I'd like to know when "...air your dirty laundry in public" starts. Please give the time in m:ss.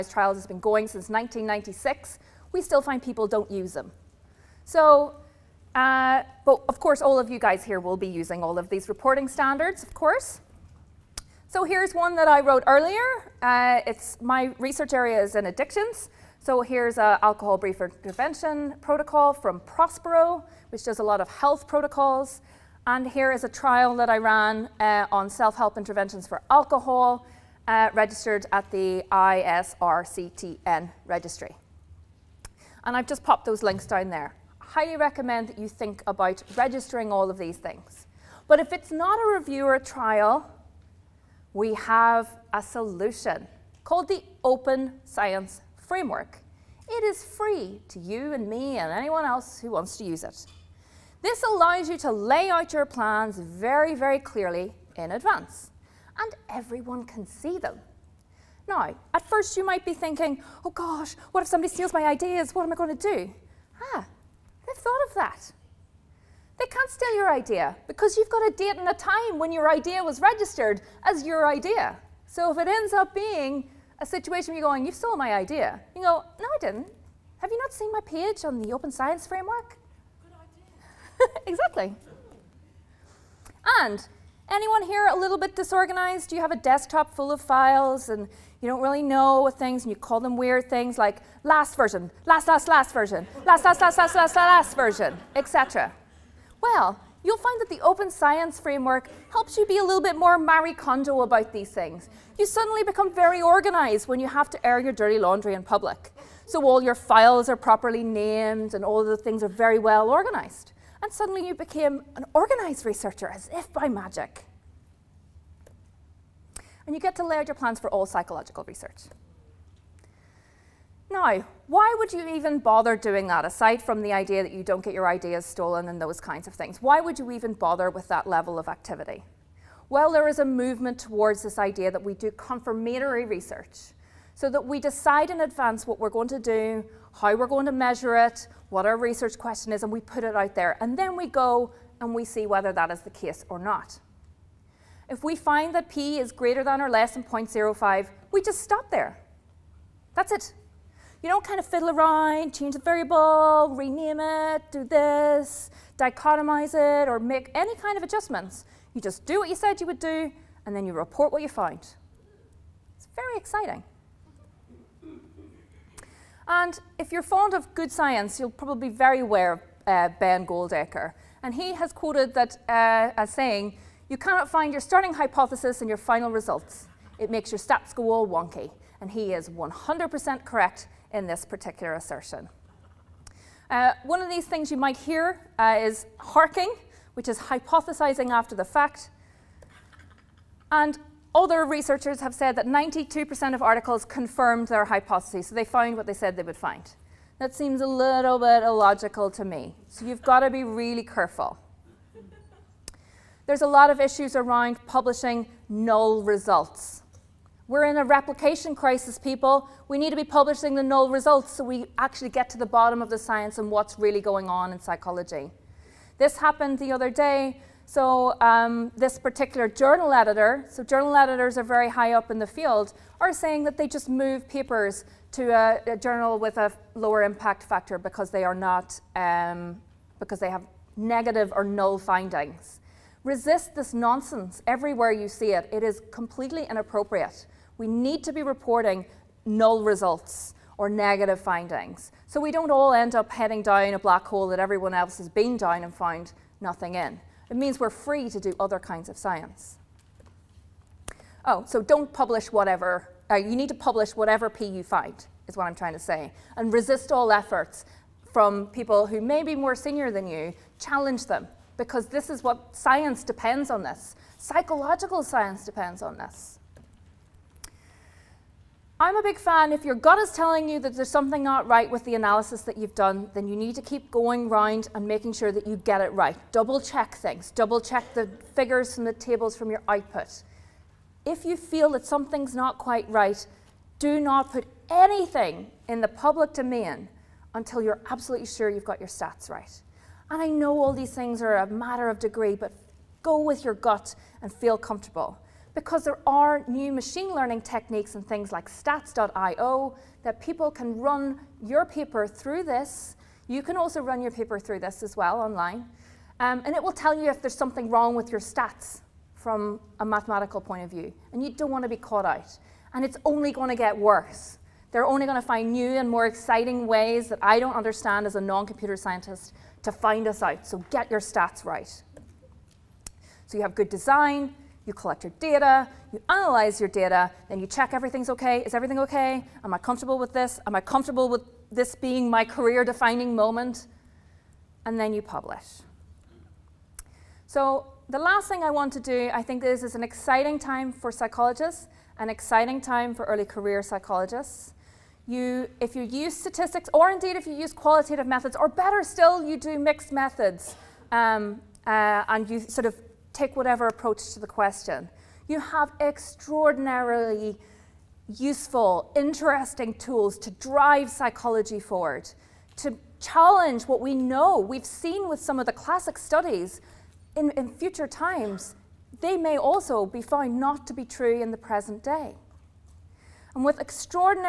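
1:44.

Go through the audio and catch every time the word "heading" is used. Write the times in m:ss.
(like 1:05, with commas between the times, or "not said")
4:03.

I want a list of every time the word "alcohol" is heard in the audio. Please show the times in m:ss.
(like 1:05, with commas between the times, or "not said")
0:17, 0:26.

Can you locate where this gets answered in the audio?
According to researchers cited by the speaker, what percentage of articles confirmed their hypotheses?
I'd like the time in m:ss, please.
3:12.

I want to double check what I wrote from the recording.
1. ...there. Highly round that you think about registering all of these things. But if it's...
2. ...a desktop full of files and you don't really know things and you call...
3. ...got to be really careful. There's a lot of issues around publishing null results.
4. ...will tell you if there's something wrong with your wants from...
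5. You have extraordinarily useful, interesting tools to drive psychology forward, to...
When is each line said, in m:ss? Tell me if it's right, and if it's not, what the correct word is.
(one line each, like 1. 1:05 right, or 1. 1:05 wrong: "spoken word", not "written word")
1. 0:34 wrong: "recommend", not "round"
2. 1:26 right
3. 3:20 right
4. 5:06 wrong: "stats", not "wants"
5. 5:55 right.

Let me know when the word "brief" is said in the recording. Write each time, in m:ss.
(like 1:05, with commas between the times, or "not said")
0:17.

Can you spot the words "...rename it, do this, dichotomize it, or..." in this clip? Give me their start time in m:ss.
2:33.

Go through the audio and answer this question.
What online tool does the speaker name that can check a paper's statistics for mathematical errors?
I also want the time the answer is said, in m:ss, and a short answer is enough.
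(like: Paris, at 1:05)
stats.io, at 4:58.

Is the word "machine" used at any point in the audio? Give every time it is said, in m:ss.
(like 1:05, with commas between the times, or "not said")
4:56.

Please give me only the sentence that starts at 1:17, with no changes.
Have you not seen my page on the Open Science Framework?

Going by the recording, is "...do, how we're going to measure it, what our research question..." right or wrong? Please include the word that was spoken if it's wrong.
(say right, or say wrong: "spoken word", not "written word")
right.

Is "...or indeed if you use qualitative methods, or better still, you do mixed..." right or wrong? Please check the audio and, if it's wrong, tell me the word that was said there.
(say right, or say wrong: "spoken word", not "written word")
right.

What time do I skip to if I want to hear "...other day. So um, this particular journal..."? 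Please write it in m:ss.
3:36.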